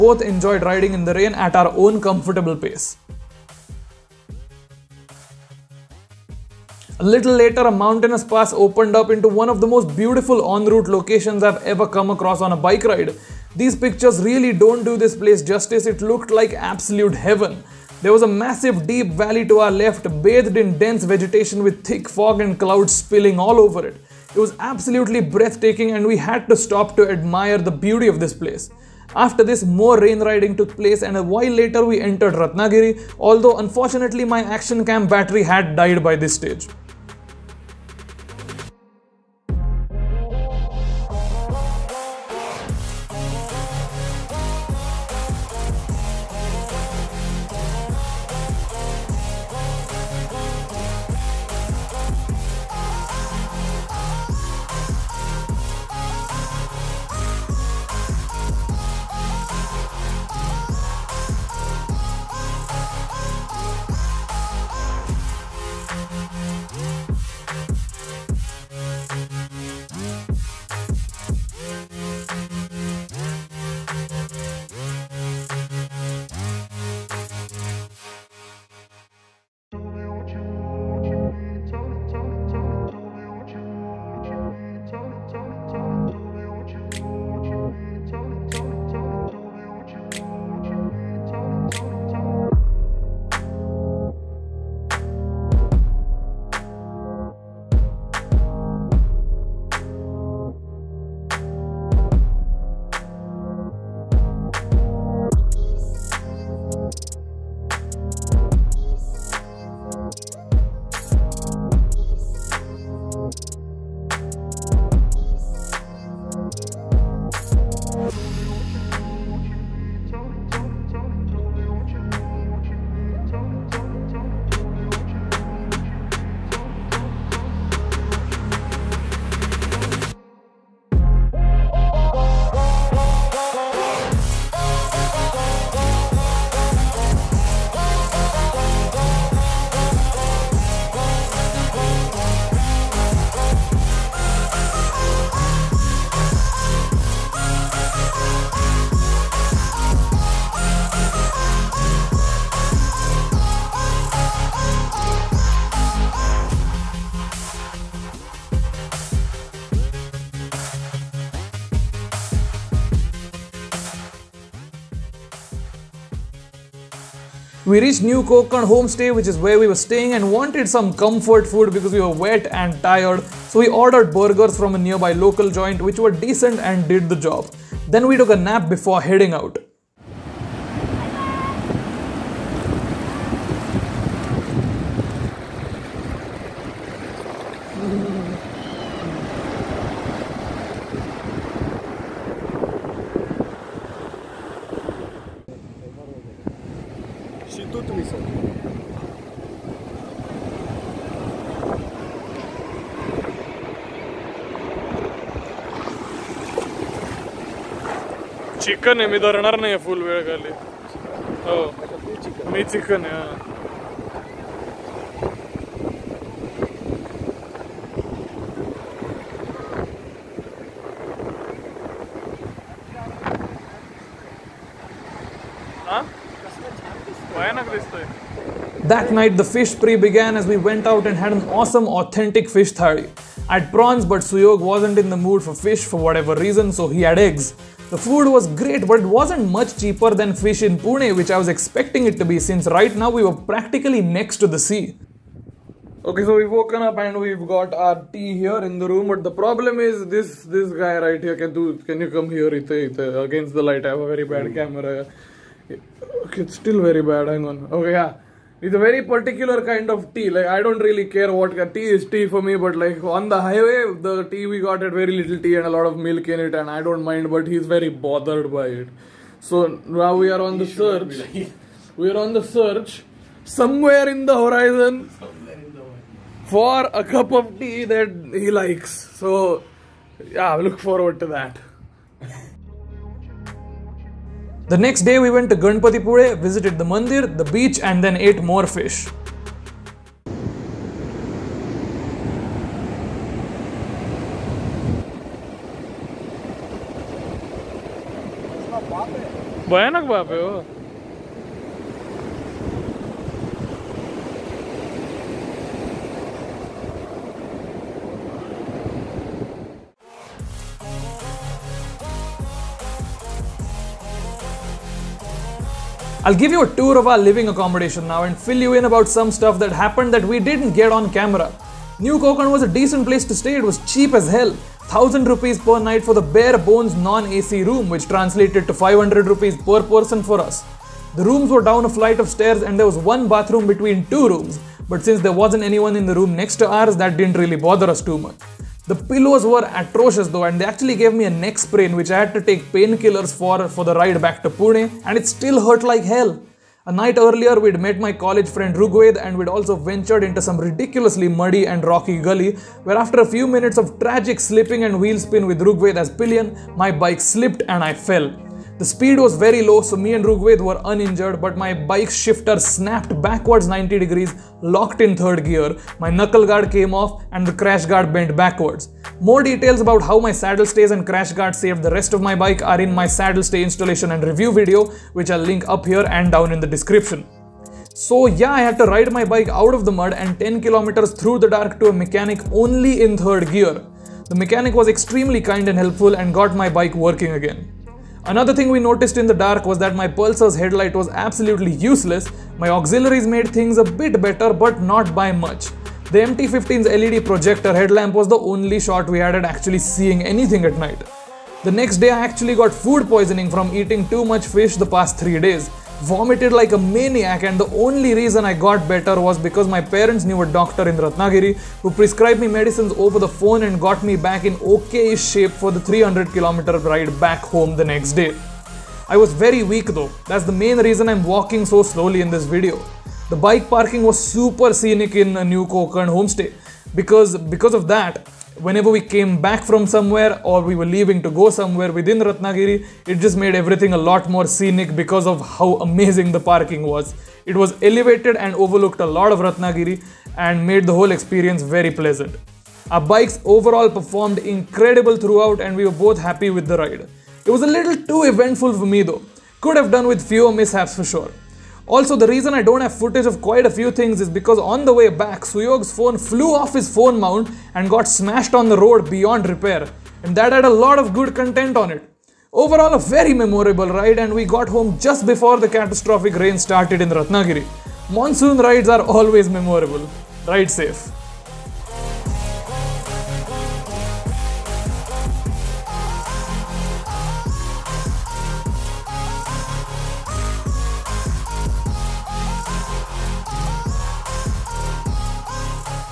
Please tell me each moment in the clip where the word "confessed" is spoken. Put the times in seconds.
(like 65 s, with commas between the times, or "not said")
not said.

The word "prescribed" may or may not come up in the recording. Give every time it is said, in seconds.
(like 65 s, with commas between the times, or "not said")
411 s.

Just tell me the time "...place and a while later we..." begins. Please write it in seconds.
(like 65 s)
30 s.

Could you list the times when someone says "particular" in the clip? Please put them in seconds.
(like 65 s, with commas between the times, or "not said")
259 s.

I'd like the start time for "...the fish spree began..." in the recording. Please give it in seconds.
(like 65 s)
229 s.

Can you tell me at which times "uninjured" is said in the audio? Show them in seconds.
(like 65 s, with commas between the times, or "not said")
360 s.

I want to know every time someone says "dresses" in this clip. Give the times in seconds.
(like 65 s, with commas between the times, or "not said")
not said.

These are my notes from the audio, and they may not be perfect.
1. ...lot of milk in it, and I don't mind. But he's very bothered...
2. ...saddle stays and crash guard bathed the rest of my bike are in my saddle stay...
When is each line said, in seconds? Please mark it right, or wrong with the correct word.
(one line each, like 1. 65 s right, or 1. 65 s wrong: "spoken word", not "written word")
1. 265 s right
2. 370 s wrong: "saved", not "bathed".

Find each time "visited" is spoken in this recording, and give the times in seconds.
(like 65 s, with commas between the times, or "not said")
286 s.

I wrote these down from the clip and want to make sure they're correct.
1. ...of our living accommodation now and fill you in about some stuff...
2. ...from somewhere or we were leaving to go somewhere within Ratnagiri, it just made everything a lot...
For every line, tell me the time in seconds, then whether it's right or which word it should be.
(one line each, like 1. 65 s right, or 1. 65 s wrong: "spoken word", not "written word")
1. 316 s right
2. 429 s right.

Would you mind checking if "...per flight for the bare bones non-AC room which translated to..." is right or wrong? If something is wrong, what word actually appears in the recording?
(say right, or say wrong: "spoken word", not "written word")
wrong: "night", not "flight".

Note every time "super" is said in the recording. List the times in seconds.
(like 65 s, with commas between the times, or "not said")
424 s.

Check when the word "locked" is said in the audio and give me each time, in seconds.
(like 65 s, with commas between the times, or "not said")
364 s.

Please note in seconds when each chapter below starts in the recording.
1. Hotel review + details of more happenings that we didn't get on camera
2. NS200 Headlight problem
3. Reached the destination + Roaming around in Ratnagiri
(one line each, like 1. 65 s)
1. 311 s
2. 387 s
3. 167 s.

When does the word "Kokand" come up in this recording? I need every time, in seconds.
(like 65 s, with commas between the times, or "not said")
168 s, 425 s.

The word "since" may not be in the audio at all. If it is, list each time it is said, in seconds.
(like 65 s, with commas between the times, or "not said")
242 s, 335 s.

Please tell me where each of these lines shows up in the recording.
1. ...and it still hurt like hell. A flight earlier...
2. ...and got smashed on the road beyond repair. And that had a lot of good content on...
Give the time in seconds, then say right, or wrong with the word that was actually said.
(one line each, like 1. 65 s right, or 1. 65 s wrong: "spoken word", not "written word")
1. 345 s wrong: "night", not "flight"
2. 457 s right.